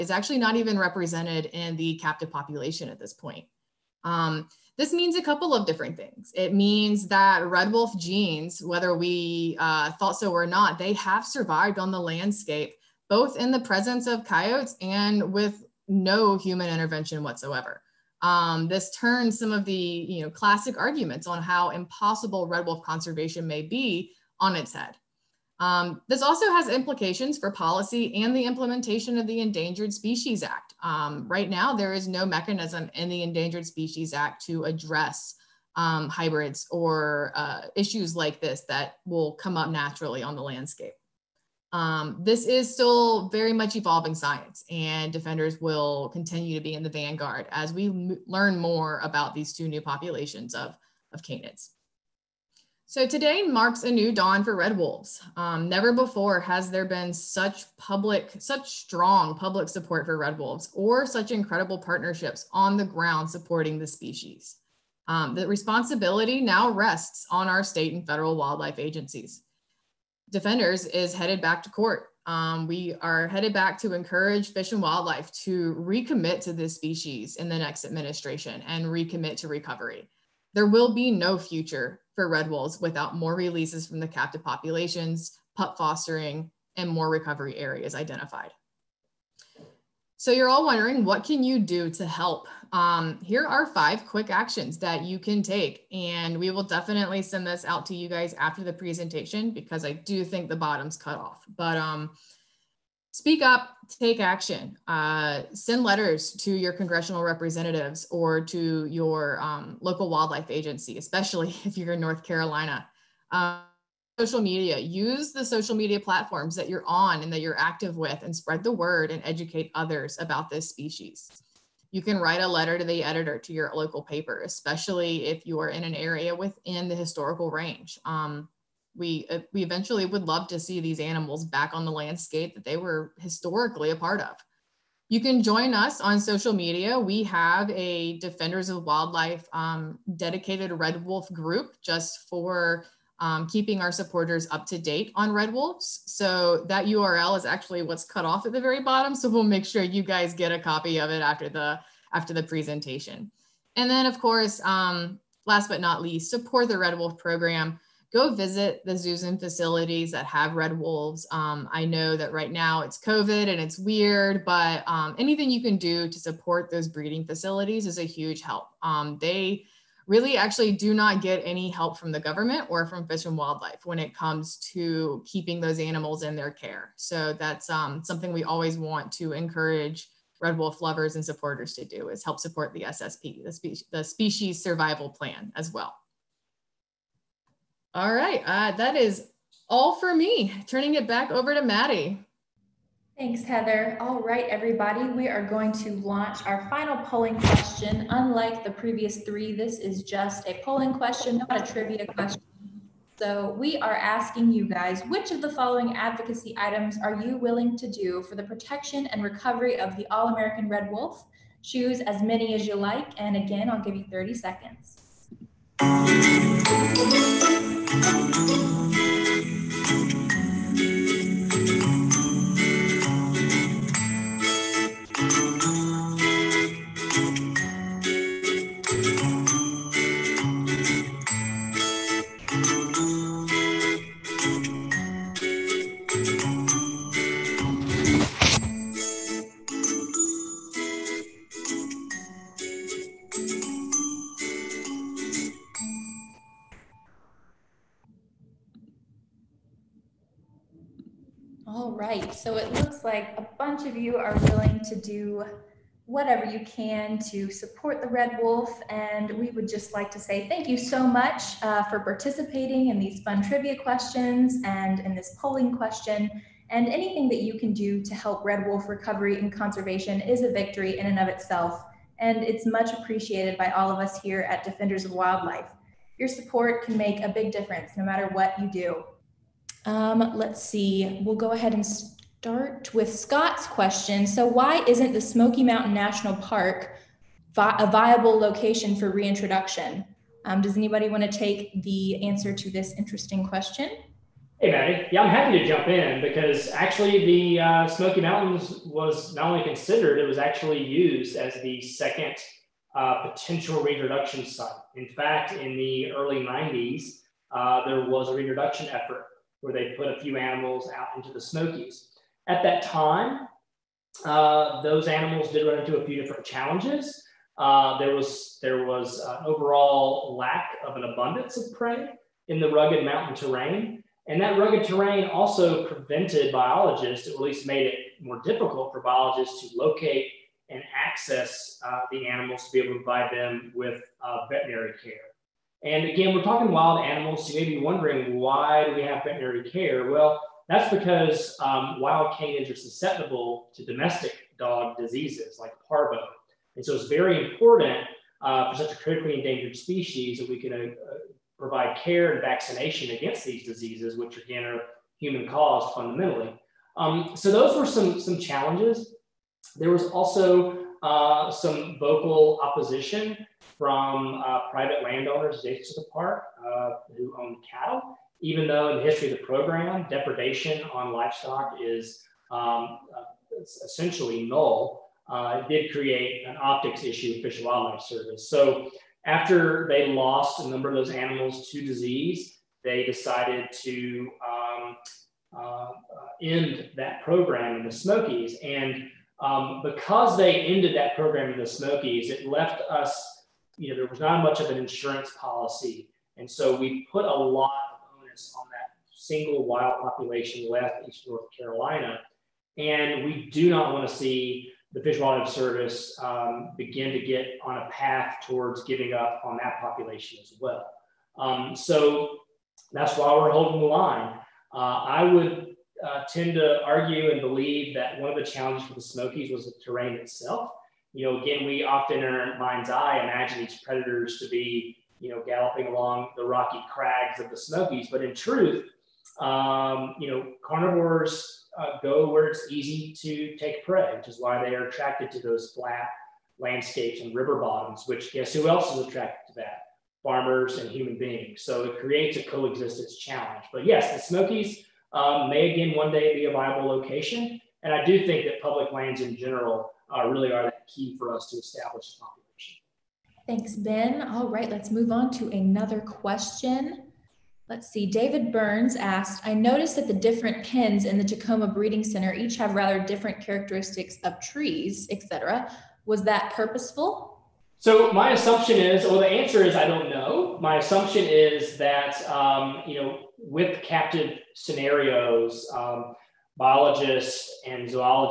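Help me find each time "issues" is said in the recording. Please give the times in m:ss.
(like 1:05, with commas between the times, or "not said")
0:37, 6:17.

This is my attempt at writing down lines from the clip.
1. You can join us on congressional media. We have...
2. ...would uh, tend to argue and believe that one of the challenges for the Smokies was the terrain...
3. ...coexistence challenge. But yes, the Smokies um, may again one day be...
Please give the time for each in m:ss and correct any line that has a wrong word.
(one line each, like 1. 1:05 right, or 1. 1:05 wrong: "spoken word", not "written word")
1. 2:15 wrong: "social", not "congressional"
2. 6:55 right
3. 7:22 right.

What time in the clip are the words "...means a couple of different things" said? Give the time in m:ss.
0:04.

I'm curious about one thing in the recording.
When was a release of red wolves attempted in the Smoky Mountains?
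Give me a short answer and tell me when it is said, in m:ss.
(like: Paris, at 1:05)
early 90s, at 5:06.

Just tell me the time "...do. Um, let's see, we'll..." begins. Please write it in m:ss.
4:38.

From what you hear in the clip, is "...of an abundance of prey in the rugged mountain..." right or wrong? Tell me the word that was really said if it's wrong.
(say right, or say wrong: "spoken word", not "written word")
right.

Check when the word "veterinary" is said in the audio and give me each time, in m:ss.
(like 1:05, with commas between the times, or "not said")
5:34, 5:39.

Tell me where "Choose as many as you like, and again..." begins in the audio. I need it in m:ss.
3:31.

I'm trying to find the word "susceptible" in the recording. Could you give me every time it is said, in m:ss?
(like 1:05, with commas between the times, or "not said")
5:42.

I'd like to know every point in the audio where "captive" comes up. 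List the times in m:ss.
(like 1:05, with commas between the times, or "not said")
0:01, 1:24, 7:53.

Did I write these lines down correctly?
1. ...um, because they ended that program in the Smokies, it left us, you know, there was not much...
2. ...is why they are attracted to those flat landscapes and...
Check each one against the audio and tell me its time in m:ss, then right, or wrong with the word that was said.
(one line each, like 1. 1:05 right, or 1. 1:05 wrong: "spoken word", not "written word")
1. 6:29 right
2. 7:14 right.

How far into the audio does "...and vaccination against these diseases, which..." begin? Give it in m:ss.
5:52.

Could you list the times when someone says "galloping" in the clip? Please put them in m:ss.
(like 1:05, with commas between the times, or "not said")
7:05.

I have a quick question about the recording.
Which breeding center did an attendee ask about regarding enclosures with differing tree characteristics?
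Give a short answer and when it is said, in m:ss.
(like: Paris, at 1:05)
Tacoma Breeding Center, at 7:41.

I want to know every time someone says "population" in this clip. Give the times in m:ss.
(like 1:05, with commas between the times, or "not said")
0:02, 0:49, 1:24, 6:40, 6:49, 7:32.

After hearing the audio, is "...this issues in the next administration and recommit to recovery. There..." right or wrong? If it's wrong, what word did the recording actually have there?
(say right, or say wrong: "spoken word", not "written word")
wrong: "species", not "issues".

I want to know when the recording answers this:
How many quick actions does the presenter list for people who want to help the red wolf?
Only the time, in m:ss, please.
1:33.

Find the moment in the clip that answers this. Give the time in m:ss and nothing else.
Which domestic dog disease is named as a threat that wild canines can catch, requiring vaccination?
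5:45.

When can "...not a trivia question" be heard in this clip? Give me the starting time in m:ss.
3:21.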